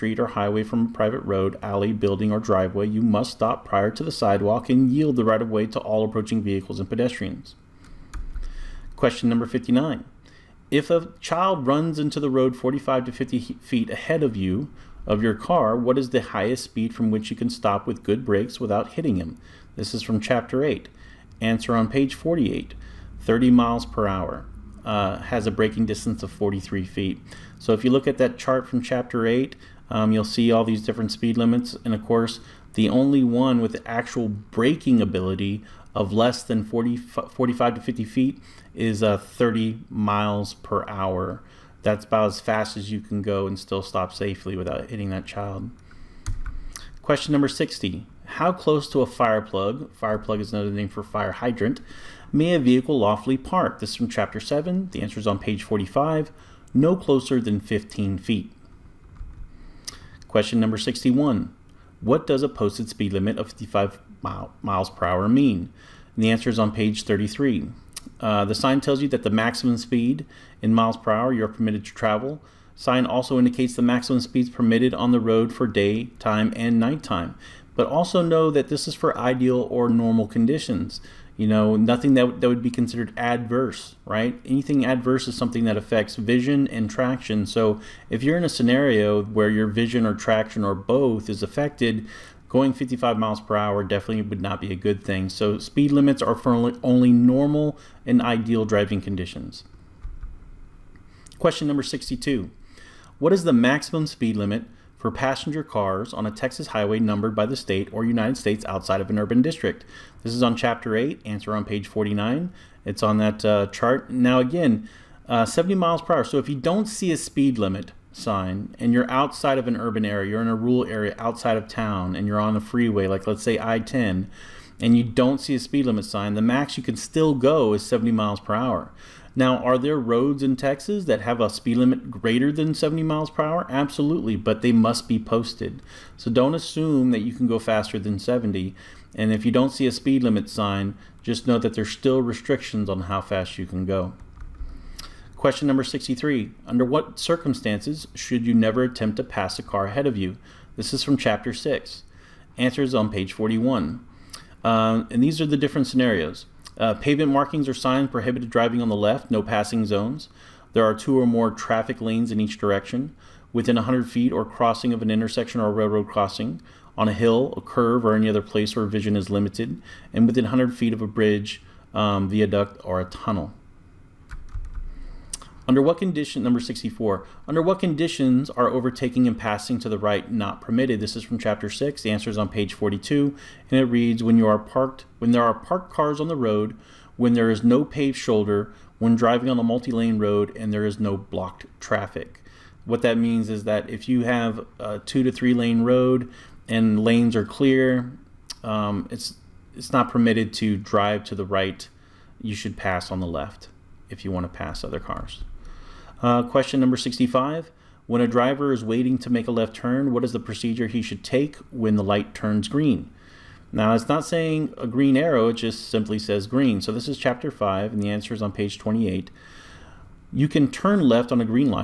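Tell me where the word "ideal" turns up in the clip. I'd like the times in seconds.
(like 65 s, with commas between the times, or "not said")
79 s, 98 s.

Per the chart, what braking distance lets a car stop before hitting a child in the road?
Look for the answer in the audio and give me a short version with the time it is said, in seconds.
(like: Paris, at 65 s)
43 feet, at 26 s.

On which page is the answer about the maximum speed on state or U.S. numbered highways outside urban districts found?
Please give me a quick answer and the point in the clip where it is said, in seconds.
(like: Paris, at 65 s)
page 49, at 111 s.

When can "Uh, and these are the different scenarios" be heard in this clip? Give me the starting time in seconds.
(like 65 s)
154 s.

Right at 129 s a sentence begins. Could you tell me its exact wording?
Now, are there roads in Texas that have a speed limit greater than 70 miles per hour?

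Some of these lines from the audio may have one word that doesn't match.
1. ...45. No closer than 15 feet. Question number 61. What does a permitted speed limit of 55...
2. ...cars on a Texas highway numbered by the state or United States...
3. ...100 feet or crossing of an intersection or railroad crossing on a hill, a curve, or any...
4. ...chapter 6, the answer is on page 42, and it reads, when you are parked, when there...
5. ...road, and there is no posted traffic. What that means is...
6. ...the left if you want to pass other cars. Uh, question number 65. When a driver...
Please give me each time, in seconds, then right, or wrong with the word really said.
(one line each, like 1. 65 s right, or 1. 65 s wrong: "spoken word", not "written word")
1. 55 s wrong: "posted", not "permitted"
2. 105 s right
3. 163 s right
4. 181 s right
5. 190 s wrong: "blocked", not "posted"
6. 203 s right.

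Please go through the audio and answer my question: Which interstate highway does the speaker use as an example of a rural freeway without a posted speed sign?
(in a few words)
I-10.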